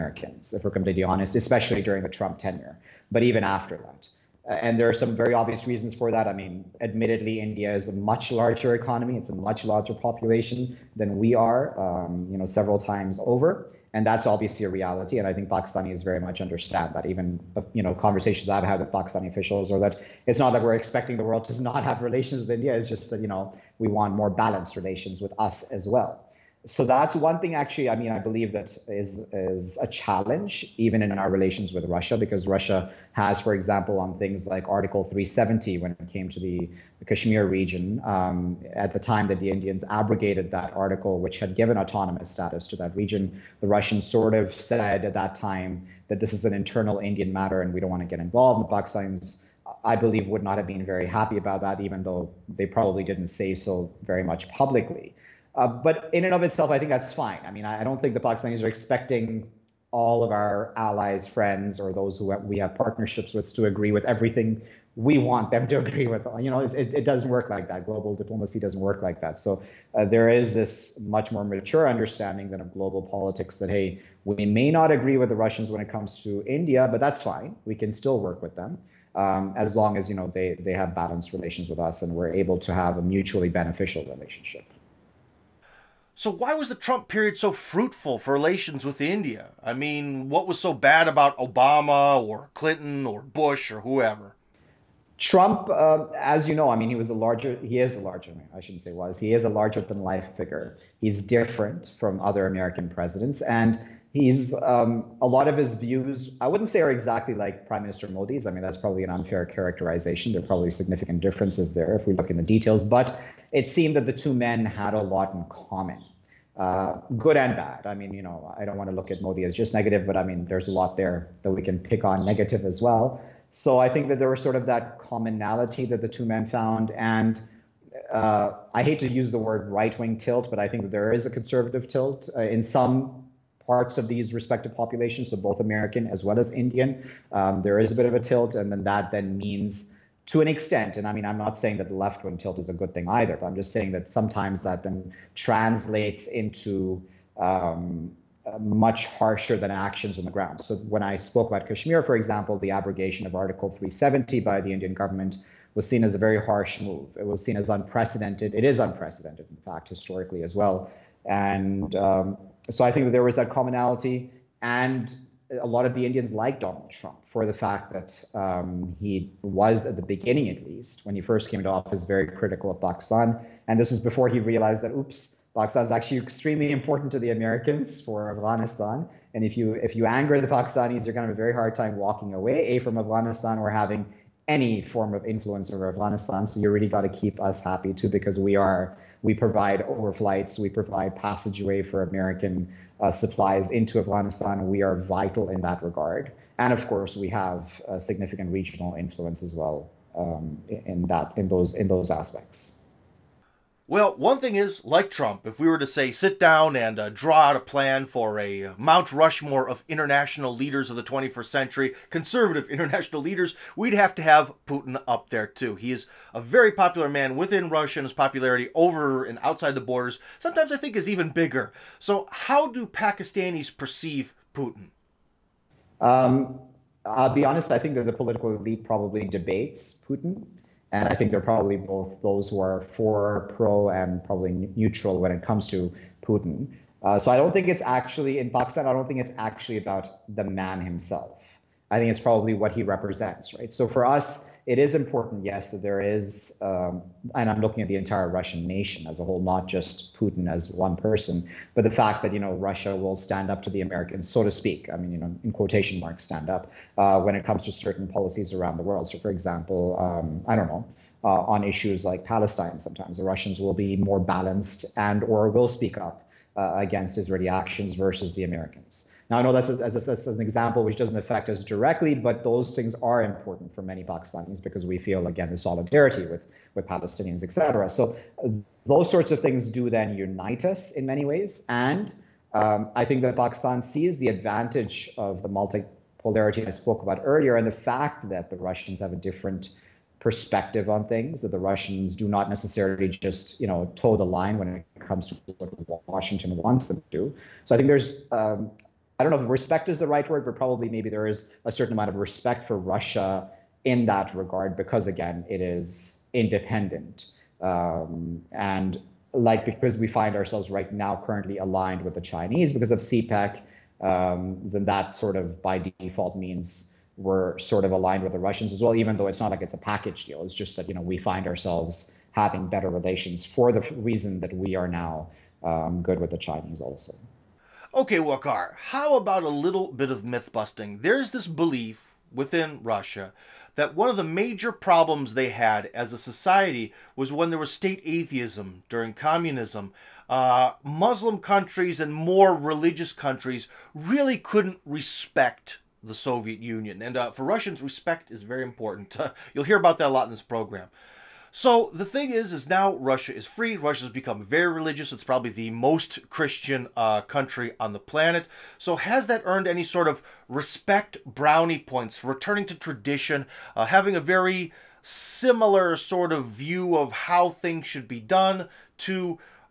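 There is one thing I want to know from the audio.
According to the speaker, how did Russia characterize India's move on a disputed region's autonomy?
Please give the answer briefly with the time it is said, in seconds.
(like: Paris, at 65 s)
An internal Indian matter, at 46 s.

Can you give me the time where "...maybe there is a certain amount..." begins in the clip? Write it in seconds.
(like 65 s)
300 s.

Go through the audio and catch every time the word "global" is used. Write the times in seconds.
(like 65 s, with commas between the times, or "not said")
67 s, 72 s.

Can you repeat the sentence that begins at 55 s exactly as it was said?
Uh, but in and of itself, I think that's fine.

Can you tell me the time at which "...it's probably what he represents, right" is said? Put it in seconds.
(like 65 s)
242 s.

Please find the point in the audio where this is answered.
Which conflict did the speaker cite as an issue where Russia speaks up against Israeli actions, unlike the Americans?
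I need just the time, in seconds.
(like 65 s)
262 s.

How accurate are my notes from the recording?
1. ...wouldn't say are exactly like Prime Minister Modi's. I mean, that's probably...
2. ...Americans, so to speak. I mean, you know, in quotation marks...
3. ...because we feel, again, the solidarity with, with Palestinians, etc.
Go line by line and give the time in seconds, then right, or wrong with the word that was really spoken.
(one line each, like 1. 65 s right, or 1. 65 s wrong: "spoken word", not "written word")
1. 106 s right
2. 253 s right
3. 274 s right.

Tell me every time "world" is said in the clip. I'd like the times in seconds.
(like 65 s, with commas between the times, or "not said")
21 s, 258 s.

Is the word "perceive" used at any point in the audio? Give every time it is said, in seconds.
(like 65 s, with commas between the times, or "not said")
223 s.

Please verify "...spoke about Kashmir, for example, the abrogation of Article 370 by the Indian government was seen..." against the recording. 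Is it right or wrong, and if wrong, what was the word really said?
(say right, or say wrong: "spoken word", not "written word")
right.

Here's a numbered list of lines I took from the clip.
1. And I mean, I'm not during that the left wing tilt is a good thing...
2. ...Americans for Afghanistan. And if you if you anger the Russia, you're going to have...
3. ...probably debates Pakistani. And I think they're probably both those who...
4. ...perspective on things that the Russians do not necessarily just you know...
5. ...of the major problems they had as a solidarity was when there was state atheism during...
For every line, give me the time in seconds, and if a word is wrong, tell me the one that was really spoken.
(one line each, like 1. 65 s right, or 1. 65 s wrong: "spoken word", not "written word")
1. 140 s wrong: "saying", not "during"
2. 177 s wrong: "Pakistanis", not "Russia"
3. 228 s wrong: "Putin", not "Pakistani"
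4. 290 s right
5. 334 s wrong: "society", not "solidarity".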